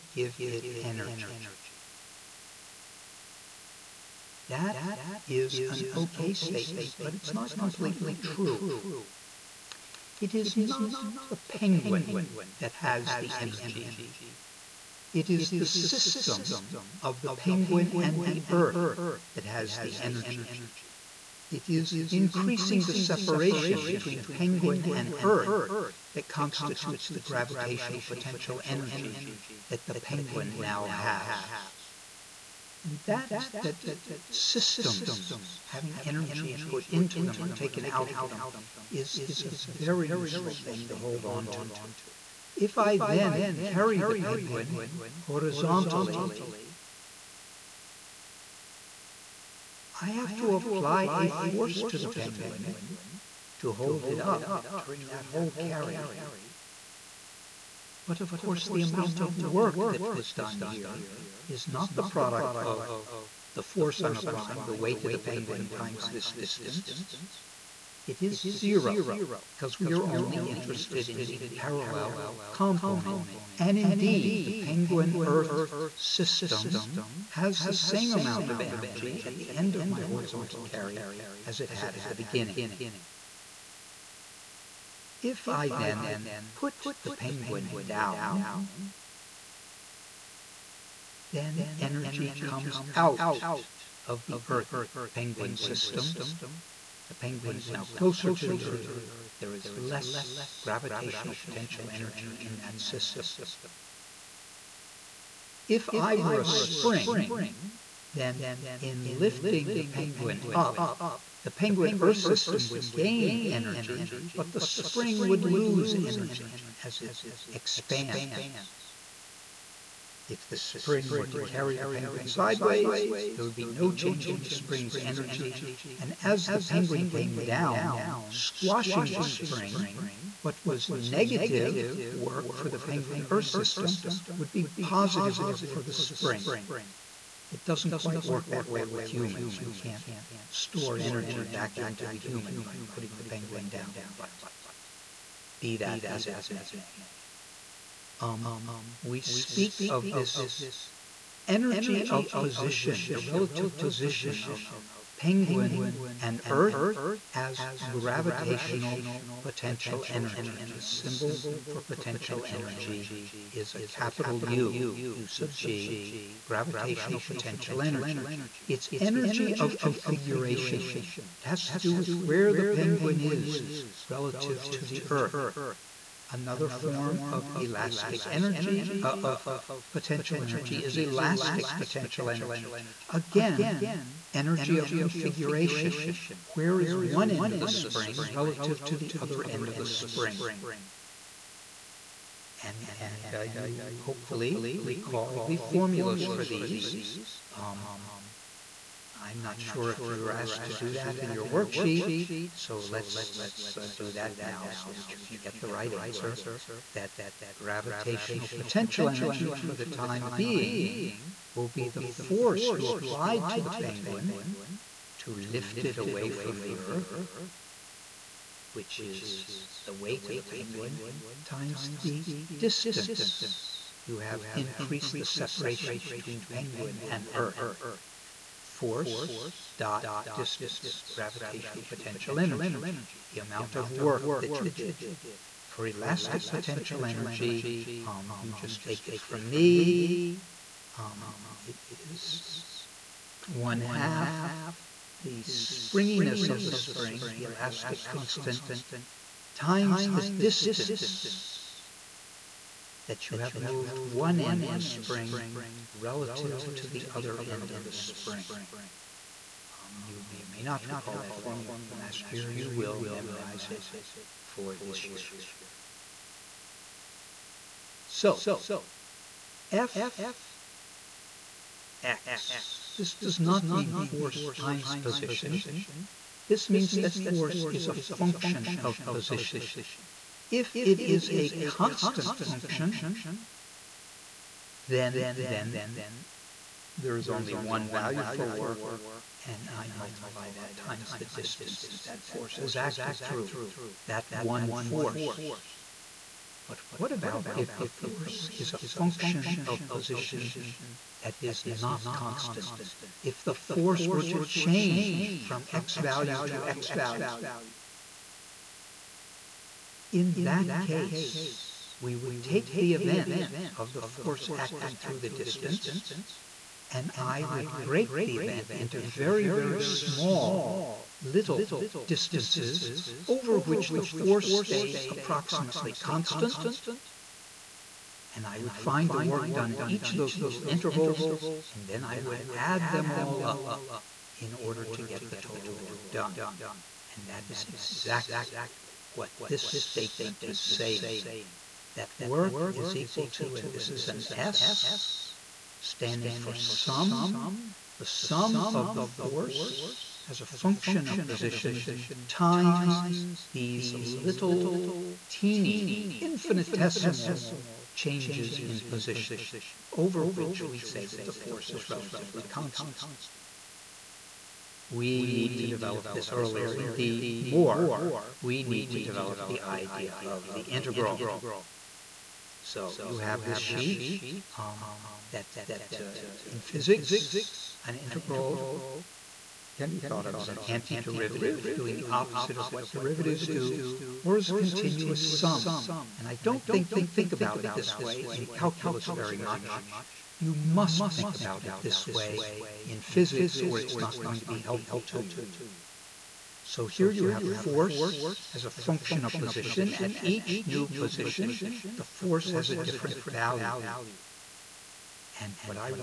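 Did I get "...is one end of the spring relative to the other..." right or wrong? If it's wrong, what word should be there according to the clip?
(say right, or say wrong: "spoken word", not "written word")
right.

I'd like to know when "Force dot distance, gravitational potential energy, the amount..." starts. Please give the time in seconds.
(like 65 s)
228 s.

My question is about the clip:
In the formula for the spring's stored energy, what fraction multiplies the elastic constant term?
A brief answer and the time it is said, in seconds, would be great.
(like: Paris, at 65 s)
one half, at 243 s.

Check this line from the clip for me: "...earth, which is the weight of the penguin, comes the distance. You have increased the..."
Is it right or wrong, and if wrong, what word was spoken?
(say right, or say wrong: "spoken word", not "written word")
wrong: "times", not "comes".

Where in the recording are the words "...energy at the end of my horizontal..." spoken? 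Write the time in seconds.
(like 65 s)
78 s.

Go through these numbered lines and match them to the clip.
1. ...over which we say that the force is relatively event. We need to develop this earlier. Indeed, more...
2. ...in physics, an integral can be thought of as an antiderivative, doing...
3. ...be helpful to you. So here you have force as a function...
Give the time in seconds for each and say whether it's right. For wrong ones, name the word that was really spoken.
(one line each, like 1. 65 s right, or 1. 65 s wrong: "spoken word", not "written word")
1. 359 s wrong: "constant", not "event"
2. 376 s right
3. 394 s right.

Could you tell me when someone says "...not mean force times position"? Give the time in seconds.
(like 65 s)
273 s.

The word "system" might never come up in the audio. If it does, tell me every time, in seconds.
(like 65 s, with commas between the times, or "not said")
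15 s, 34 s, 75 s, 95 s, 102 s, 112 s, 133 s.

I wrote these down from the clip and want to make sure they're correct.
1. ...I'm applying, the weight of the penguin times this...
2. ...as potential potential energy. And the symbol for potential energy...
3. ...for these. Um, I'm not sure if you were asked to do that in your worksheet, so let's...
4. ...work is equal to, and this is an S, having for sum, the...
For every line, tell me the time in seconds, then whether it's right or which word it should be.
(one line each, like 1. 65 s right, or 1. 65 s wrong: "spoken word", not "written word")
1. 64 s right
2. 157 s wrong: "gravitational", not "potential"
3. 196 s right
4. 342 s wrong: "standing", not "having".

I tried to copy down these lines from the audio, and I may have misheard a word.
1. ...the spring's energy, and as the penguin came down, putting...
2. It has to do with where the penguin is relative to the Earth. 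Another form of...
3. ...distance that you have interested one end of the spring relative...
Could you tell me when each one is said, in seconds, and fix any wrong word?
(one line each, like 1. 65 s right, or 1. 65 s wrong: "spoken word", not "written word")
1. 124 s wrong: "squashing", not "putting"
2. 171 s right
3. 250 s wrong: "moved", not "interested".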